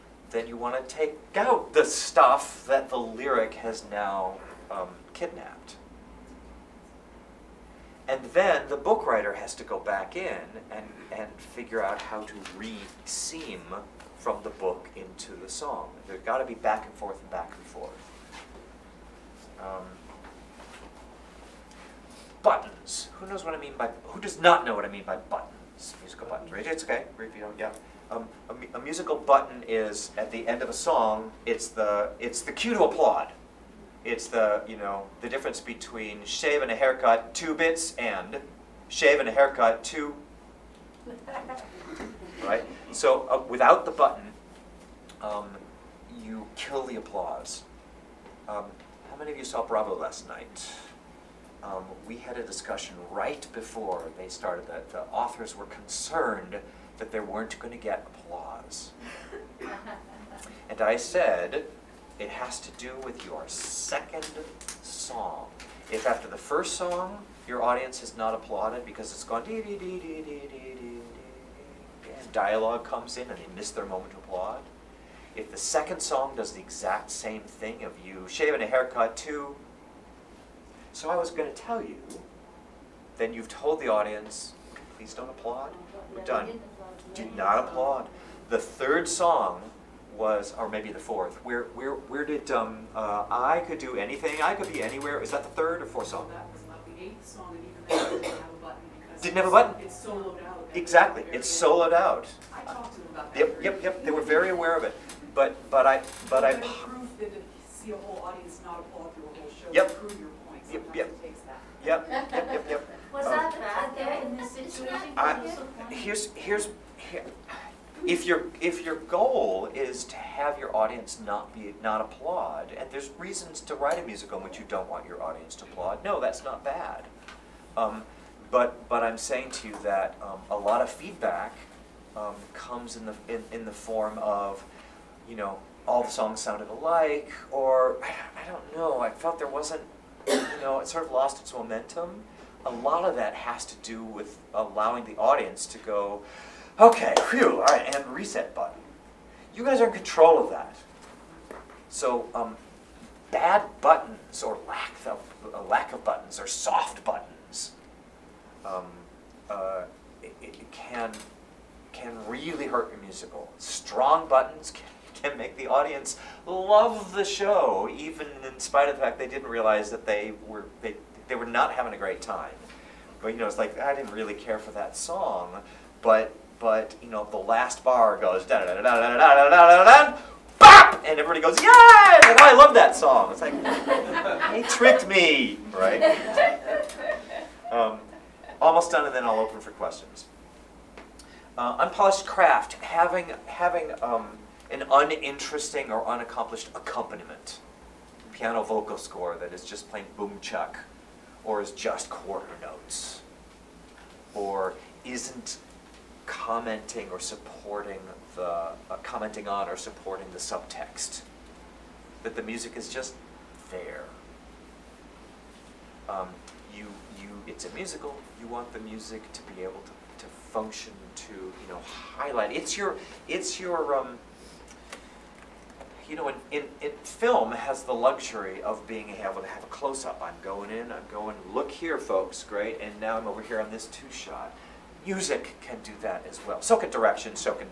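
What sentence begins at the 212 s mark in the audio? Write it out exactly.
That the music is just there.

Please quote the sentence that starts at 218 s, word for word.
You want the music to be able to, to function to you know highlight.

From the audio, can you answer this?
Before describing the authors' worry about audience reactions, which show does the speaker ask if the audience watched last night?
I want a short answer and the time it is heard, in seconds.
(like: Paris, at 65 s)
Bravo, at 49 s.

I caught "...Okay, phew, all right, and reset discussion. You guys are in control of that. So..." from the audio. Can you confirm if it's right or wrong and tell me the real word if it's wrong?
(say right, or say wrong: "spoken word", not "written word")
wrong: "button", not "discussion".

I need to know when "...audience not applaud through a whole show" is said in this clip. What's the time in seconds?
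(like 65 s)
108 s.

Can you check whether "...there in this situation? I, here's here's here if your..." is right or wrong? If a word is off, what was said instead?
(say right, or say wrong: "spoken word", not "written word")
right.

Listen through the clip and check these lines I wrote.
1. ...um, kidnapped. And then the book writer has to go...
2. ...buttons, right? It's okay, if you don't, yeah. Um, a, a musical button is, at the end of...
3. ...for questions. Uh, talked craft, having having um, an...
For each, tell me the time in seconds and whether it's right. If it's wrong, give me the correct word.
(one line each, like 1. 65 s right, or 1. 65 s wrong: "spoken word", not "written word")
1. 4 s right
2. 26 s right
3. 189 s wrong: "unpolished", not "talked".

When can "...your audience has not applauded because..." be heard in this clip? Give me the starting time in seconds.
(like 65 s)
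67 s.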